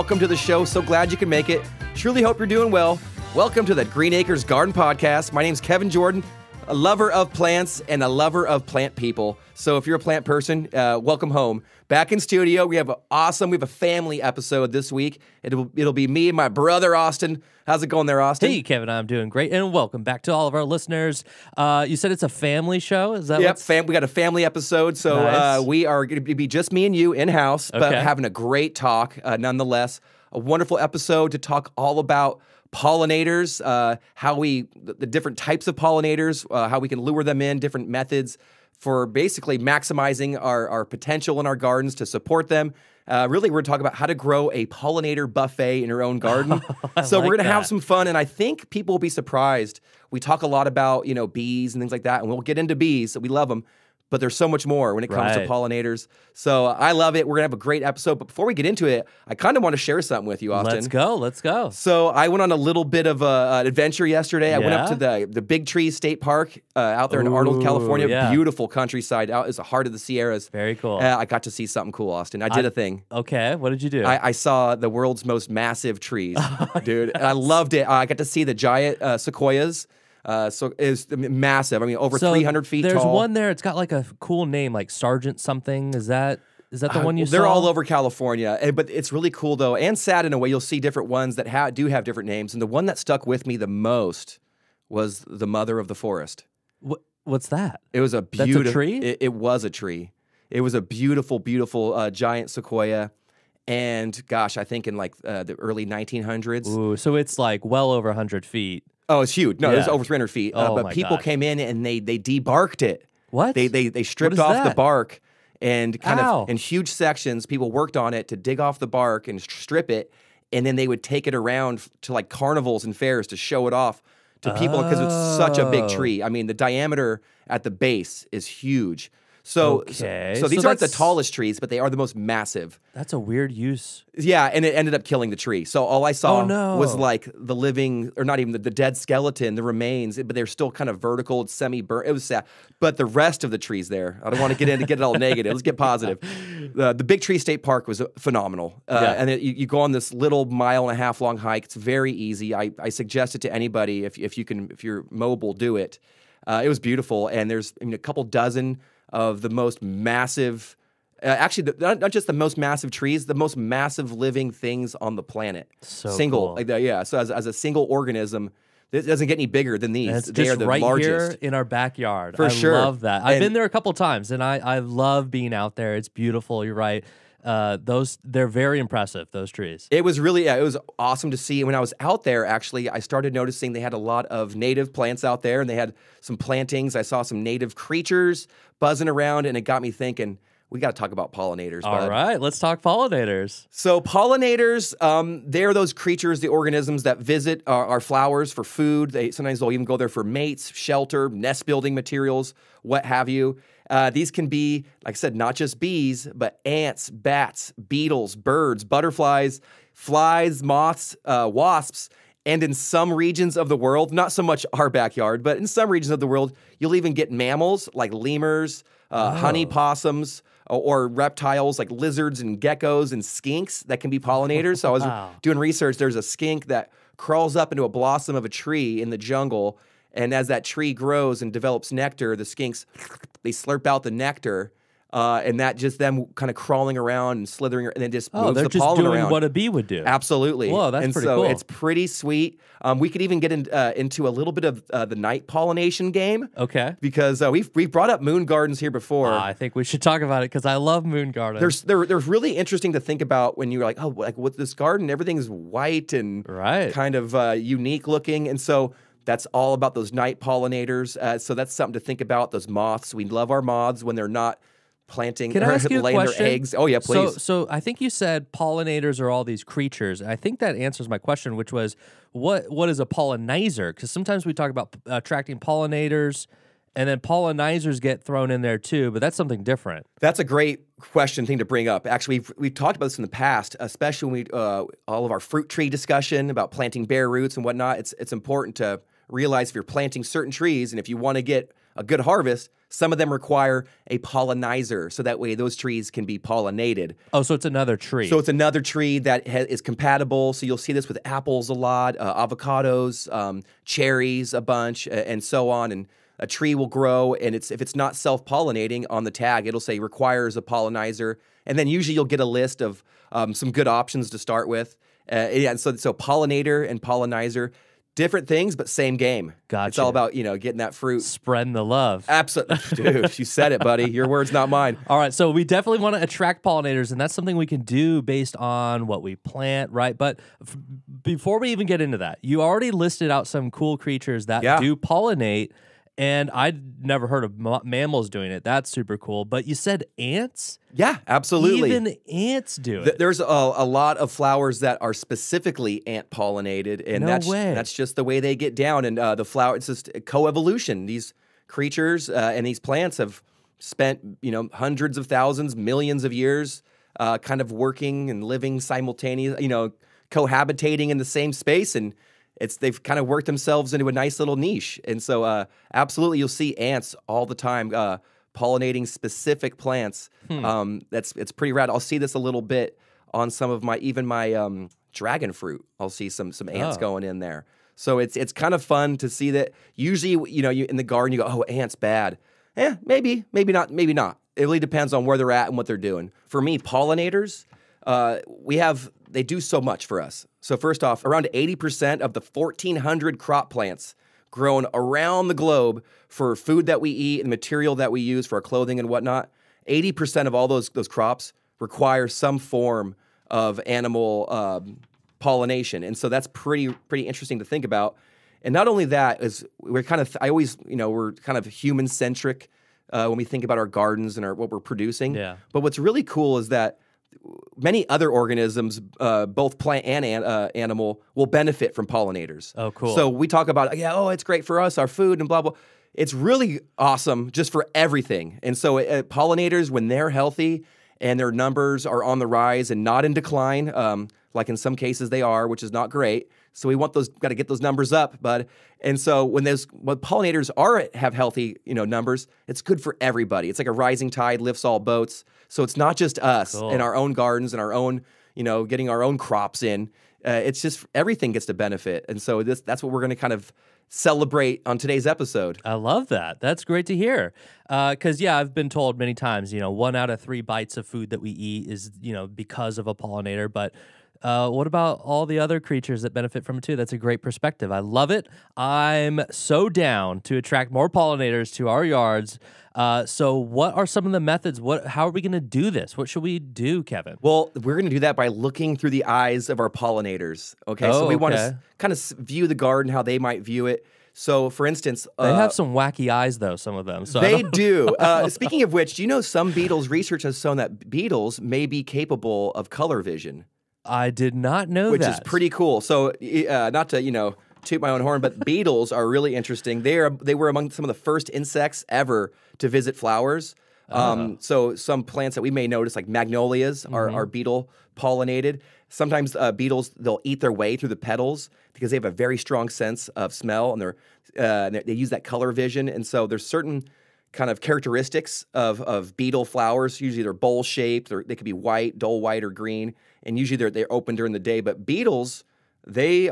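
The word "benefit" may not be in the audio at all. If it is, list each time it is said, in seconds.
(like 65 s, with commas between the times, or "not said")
421 s, 451 s, 466 s.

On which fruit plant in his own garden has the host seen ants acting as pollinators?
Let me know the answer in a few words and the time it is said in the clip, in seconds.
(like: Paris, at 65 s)
Dragon fruit, at 375 s.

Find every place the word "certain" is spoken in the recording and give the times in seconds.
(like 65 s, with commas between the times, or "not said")
290 s, 516 s.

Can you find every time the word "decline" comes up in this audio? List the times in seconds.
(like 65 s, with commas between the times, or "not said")
433 s.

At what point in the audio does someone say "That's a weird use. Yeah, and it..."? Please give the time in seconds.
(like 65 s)
132 s.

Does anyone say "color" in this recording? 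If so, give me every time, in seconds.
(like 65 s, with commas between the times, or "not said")
492 s, 515 s.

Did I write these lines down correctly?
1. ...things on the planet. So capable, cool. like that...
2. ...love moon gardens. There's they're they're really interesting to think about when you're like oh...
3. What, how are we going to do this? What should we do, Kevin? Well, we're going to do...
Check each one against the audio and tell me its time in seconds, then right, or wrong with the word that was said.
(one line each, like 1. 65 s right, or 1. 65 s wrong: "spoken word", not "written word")
1. 164 s wrong: "single", not "capable"
2. 250 s right
3. 474 s right.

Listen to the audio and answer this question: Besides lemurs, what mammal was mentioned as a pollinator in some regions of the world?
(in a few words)
Honey possums.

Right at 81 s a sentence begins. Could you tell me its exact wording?
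I mean, over so 300 feet there's tall.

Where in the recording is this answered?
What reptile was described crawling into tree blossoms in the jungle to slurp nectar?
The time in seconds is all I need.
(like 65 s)
226 s.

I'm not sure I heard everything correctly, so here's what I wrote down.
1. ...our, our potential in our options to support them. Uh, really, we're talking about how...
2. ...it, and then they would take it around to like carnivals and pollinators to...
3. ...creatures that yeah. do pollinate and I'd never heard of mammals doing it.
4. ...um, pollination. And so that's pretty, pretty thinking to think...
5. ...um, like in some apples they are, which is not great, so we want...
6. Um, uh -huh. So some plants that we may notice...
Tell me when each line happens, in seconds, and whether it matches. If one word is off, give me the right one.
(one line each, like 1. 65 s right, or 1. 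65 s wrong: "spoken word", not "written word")
1. 40 s wrong: "gardens", not "options"
2. 119 s wrong: "fairs", not "pollinators"
3. 333 s right
4. 404 s wrong: "interesting", not "thinking"
5. 433 s wrong: "cases", not "apples"
6. 504 s right.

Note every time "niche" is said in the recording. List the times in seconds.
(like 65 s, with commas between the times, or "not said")
364 s.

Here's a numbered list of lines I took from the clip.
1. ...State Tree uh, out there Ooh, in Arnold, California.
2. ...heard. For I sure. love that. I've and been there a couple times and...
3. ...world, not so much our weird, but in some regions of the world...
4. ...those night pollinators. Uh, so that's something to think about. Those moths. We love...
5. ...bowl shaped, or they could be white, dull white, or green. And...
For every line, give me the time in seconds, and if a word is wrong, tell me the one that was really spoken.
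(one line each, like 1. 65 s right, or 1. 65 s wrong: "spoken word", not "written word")
1. 65 s wrong: "Park", not "Tree"
2. 171 s wrong: "backyard", not "heard"
3. 213 s wrong: "backyard", not "weird"
4. 259 s right
5. 520 s right.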